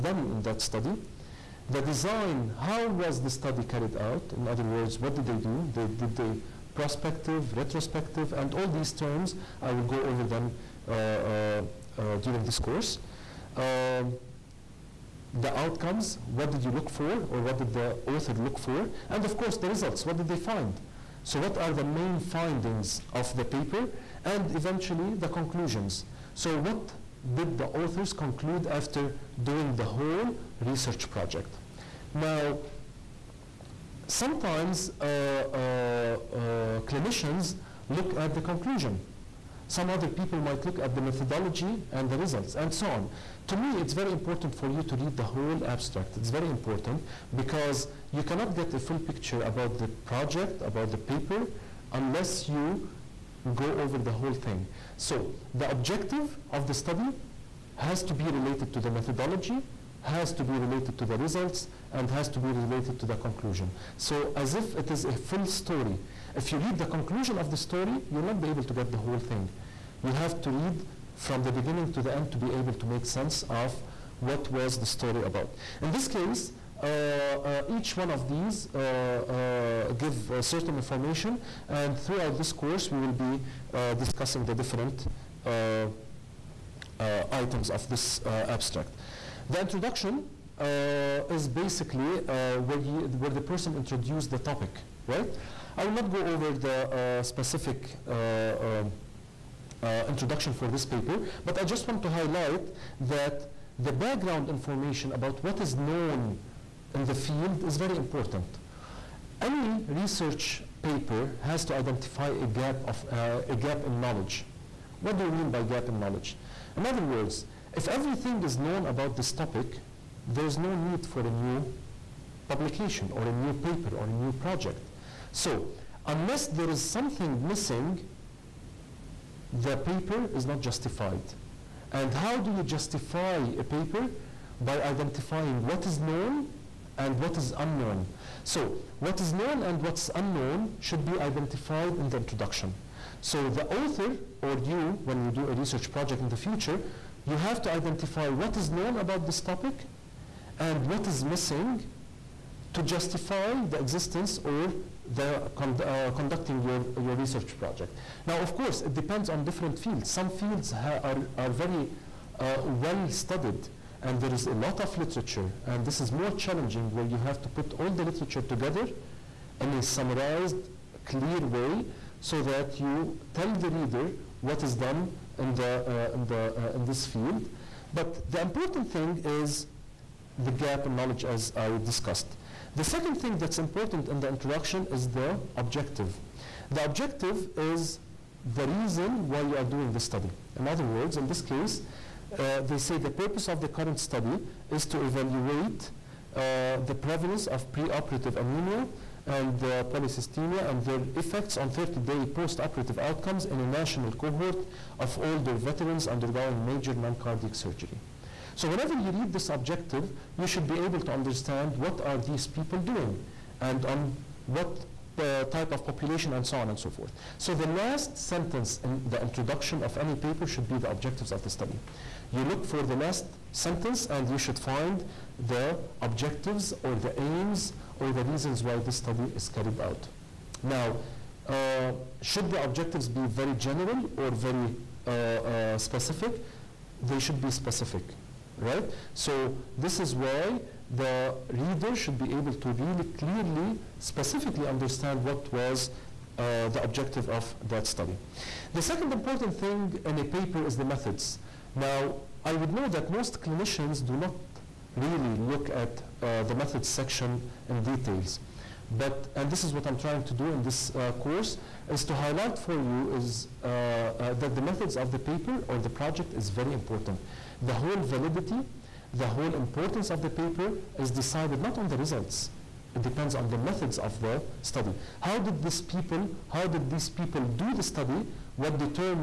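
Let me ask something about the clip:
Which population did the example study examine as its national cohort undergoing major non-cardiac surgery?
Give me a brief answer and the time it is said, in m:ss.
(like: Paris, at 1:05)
Older veterans, at 3:25.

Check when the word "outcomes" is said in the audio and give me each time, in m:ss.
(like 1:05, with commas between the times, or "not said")
0:15, 3:23.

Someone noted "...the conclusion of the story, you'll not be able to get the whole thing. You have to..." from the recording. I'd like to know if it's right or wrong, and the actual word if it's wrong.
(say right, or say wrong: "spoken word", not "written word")
right.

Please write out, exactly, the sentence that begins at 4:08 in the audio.
The second important thing in a paper is the methods.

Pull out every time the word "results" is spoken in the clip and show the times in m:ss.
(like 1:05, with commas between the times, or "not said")
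0:19, 0:42, 1:01, 4:31.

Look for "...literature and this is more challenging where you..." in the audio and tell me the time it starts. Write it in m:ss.
2:44.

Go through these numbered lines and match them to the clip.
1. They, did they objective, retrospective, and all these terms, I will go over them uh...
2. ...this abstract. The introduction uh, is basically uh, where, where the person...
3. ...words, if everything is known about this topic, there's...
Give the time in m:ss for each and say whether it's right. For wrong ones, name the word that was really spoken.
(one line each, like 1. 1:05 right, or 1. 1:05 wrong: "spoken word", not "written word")
1. 0:05 wrong: "prospective", not "objective"
2. 1:27 right
3. 1:57 right.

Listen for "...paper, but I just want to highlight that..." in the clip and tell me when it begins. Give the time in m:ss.
1:40.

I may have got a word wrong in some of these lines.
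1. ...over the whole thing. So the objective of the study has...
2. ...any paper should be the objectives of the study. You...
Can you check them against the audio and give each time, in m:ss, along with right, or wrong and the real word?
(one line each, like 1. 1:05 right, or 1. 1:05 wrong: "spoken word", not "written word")
1. 0:53 right
2. 3:39 right.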